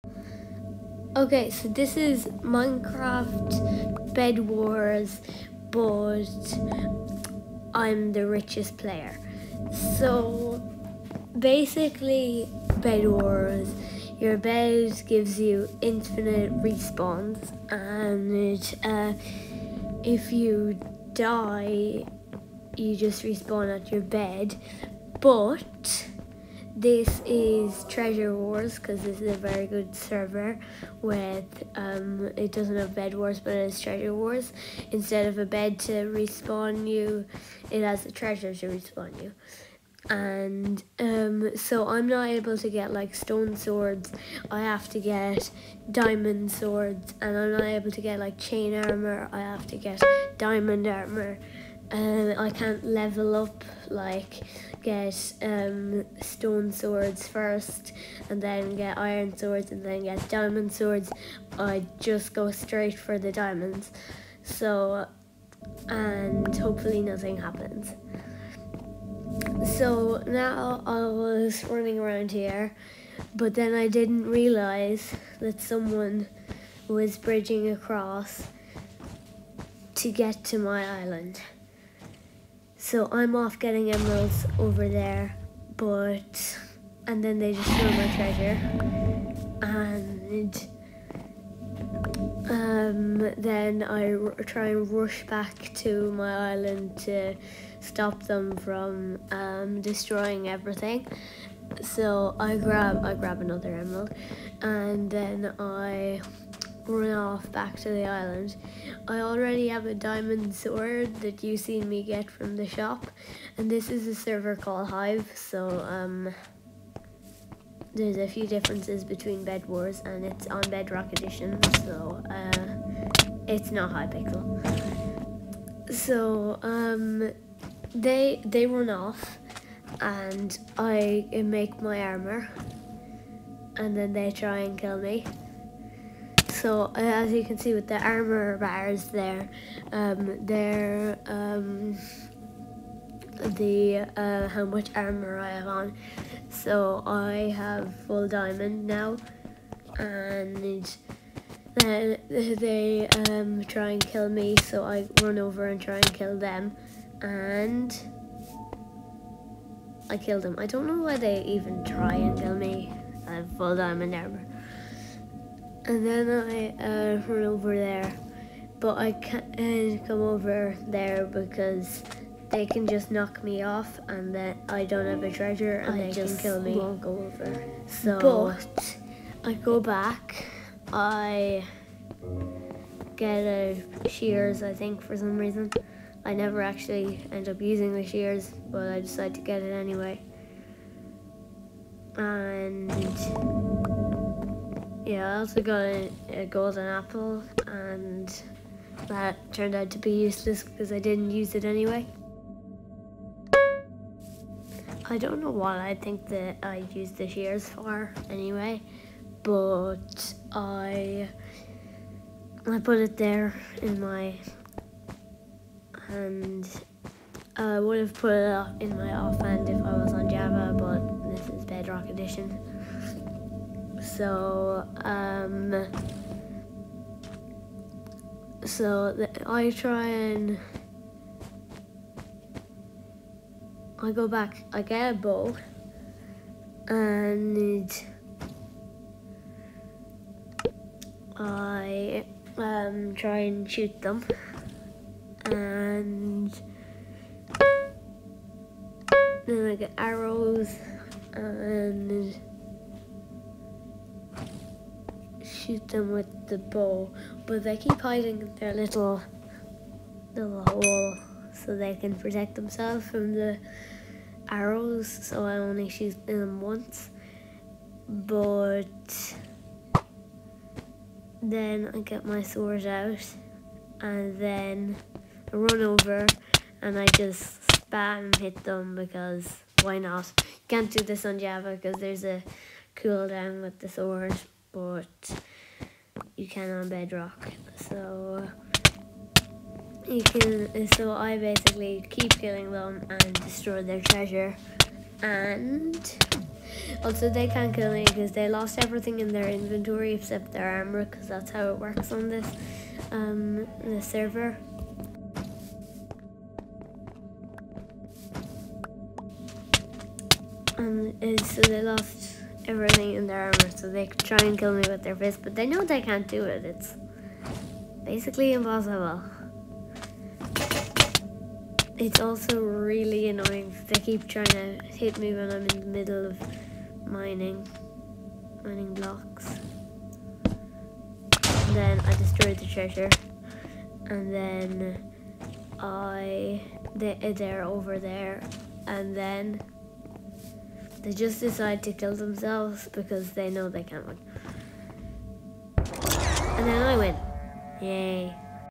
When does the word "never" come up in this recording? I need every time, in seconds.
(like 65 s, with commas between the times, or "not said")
186 s.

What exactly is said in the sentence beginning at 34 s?
Instead of a bed to respawn you, it has a treasure to respawn you.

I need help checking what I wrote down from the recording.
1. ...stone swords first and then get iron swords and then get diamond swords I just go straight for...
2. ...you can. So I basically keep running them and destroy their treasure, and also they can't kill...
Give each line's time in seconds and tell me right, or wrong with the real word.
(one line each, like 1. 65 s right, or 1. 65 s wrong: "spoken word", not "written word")
1. 56 s right
2. 290 s wrong: "killing", not "running".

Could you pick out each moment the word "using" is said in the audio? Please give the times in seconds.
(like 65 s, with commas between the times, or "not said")
187 s.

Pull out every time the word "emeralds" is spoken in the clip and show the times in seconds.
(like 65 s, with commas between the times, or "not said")
83 s, 103 s.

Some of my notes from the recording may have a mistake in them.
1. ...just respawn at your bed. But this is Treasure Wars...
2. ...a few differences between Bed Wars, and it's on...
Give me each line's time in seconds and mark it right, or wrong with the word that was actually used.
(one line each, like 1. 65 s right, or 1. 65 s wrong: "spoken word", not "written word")
1. 22 s right
2. 118 s right.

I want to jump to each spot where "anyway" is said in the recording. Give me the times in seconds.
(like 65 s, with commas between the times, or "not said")
189 s, 201 s, 208 s.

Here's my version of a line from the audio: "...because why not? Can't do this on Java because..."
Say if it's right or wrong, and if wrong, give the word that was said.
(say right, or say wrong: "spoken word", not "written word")
right.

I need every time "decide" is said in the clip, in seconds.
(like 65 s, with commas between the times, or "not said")
189 s, 341 s.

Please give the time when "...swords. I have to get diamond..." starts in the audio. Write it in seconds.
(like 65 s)
43 s.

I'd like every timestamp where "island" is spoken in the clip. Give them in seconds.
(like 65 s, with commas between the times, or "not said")
81 s, 96 s, 108 s.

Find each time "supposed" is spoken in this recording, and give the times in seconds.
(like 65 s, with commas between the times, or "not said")
not said.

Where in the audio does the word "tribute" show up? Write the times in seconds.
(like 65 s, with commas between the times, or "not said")
not said.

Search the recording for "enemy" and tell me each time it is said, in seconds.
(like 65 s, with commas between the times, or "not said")
not said.